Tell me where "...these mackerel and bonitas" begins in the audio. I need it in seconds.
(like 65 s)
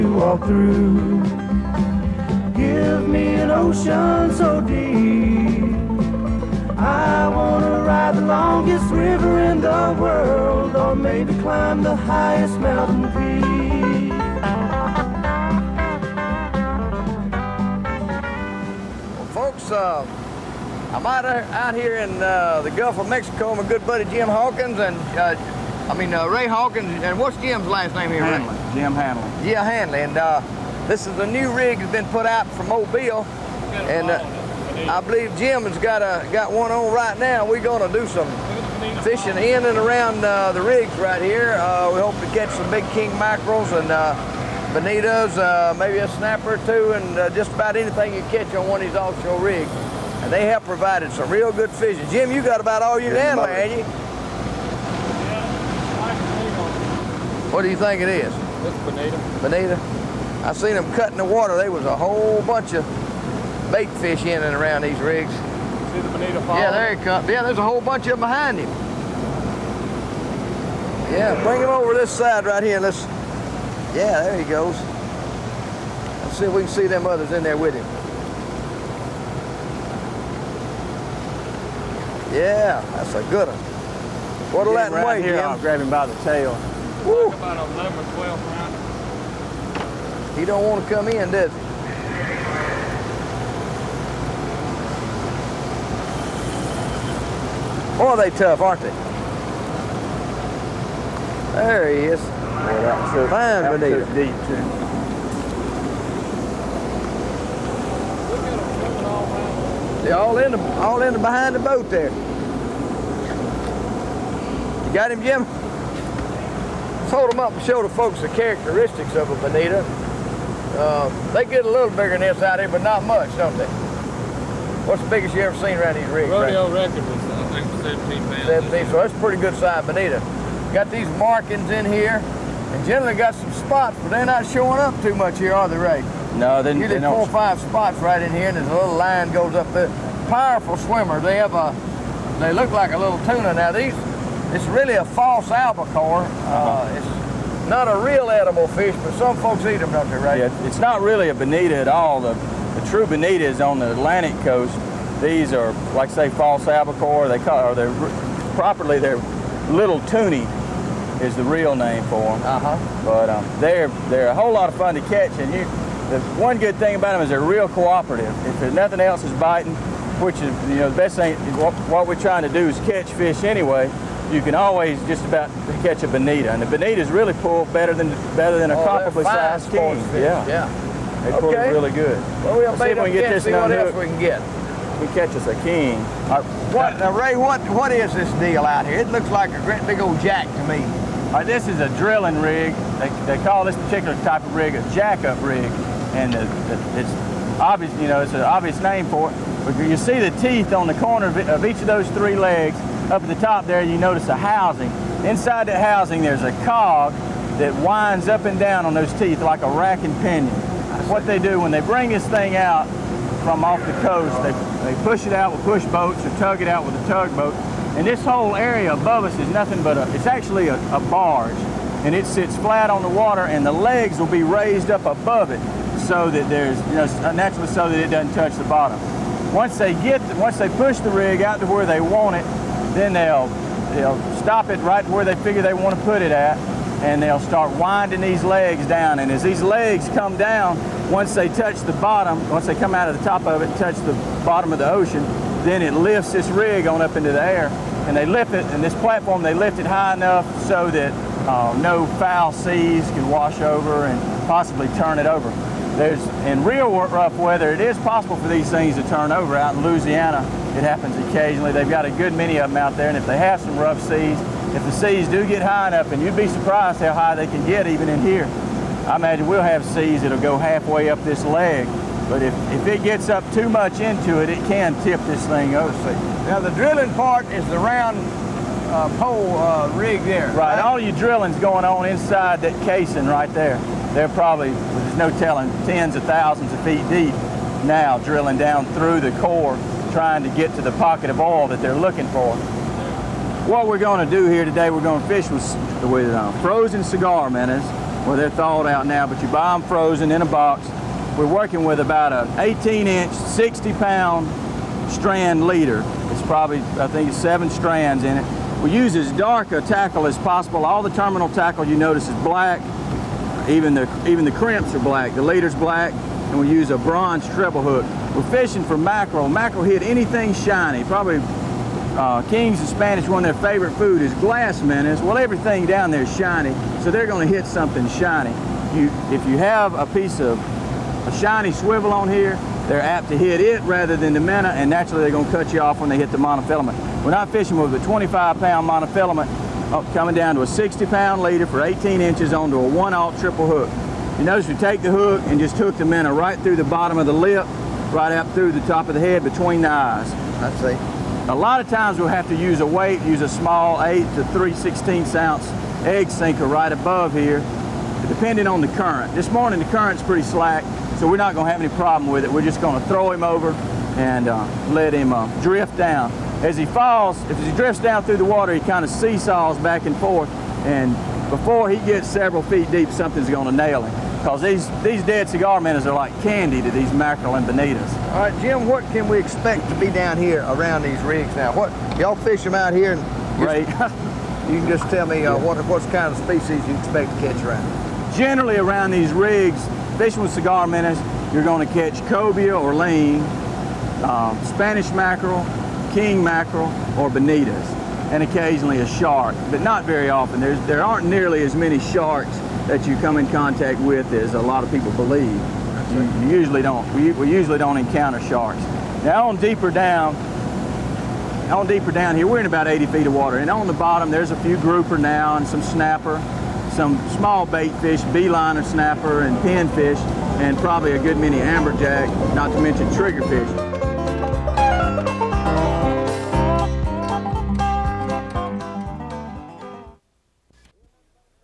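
376 s.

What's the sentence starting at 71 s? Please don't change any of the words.
Yeah, bring him over this side right here.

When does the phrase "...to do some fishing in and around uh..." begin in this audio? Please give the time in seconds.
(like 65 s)
37 s.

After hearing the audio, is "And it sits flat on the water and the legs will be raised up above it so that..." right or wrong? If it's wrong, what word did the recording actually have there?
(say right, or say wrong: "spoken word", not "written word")
right.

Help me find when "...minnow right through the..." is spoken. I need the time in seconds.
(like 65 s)
346 s.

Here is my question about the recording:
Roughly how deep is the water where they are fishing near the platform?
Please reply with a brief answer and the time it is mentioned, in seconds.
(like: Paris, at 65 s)
80 feet, at 412 s.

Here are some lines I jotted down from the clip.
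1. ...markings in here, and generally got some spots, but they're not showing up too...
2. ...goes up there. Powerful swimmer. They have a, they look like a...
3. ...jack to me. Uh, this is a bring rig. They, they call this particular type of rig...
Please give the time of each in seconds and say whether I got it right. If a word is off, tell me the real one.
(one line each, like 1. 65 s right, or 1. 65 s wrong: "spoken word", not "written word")
1. 131 s right
2. 139 s right
3. 190 s wrong: "drilling", not "bring".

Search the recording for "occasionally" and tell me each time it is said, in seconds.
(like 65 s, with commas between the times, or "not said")
261 s, 398 s.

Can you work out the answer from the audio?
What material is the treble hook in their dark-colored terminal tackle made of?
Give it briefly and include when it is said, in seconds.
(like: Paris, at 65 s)
bronze, at 316 s.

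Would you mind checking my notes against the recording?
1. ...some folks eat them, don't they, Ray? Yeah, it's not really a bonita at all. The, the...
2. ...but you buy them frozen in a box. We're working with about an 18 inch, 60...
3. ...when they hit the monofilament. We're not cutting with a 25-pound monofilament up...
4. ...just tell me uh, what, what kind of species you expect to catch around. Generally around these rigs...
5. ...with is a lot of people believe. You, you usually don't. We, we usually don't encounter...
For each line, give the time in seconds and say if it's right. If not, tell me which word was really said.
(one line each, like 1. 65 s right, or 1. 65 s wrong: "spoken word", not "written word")
1. 149 s right
2. 299 s right
3. 335 s wrong: "fishing", not "cutting"
4. 384 s right
5. 403 s right.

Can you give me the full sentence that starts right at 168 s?
If there's nothing else is biting, which is you know the best thing.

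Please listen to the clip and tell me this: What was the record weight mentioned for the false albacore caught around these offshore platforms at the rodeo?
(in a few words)
17 pounds.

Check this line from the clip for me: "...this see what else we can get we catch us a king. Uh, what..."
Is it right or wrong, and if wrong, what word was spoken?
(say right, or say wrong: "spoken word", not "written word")
right.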